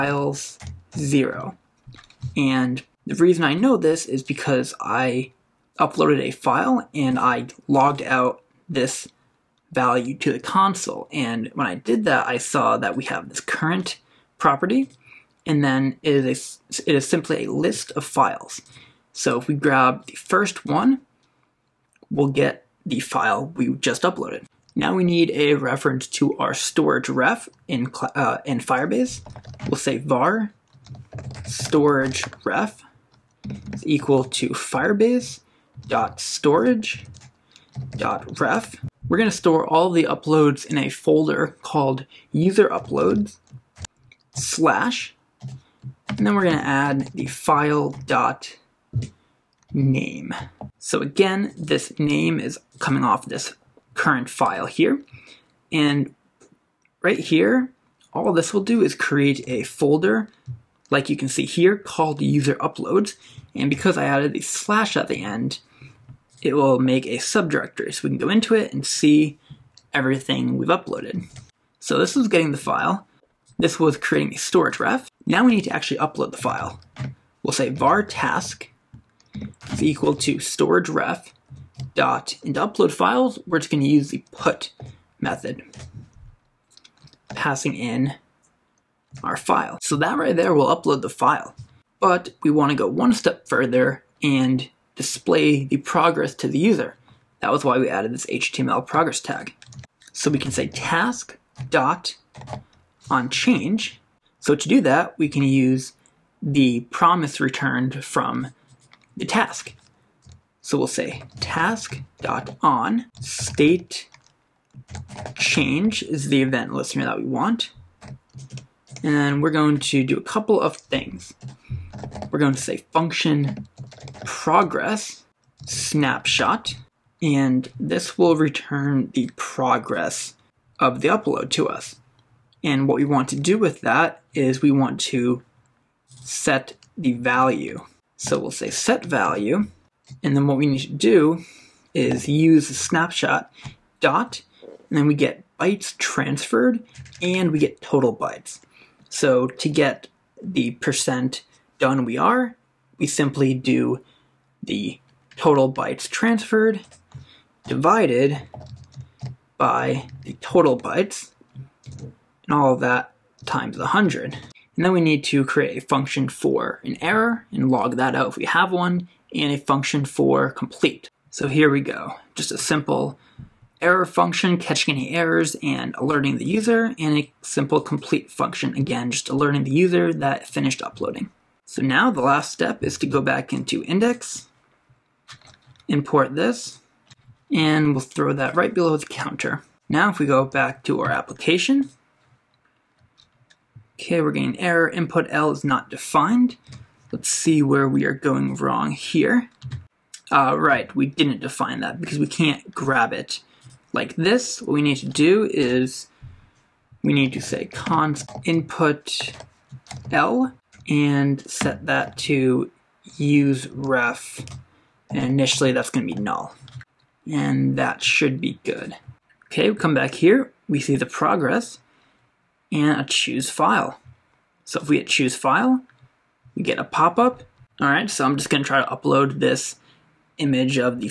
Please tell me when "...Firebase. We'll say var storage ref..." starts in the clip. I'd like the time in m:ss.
0:28.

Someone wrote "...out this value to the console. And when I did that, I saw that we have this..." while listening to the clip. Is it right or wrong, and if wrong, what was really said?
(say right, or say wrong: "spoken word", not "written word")
right.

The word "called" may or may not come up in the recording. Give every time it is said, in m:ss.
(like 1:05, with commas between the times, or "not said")
0:41, 1:01.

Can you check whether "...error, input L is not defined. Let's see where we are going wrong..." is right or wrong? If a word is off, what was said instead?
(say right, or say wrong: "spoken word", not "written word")
right.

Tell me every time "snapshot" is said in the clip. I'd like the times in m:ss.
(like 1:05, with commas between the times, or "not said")
2:05, 2:22.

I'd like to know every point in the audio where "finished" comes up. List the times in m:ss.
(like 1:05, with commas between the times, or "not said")
3:00.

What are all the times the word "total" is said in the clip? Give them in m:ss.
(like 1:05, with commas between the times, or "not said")
2:27, 2:35, 2:40.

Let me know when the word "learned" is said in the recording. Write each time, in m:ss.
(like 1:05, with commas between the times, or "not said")
not said.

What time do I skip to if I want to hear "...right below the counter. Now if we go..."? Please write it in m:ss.
3:08.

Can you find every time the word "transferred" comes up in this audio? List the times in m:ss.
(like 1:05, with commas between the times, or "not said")
2:25, 2:36.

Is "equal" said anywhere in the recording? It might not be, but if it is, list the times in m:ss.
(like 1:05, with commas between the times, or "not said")
0:33, 1:19.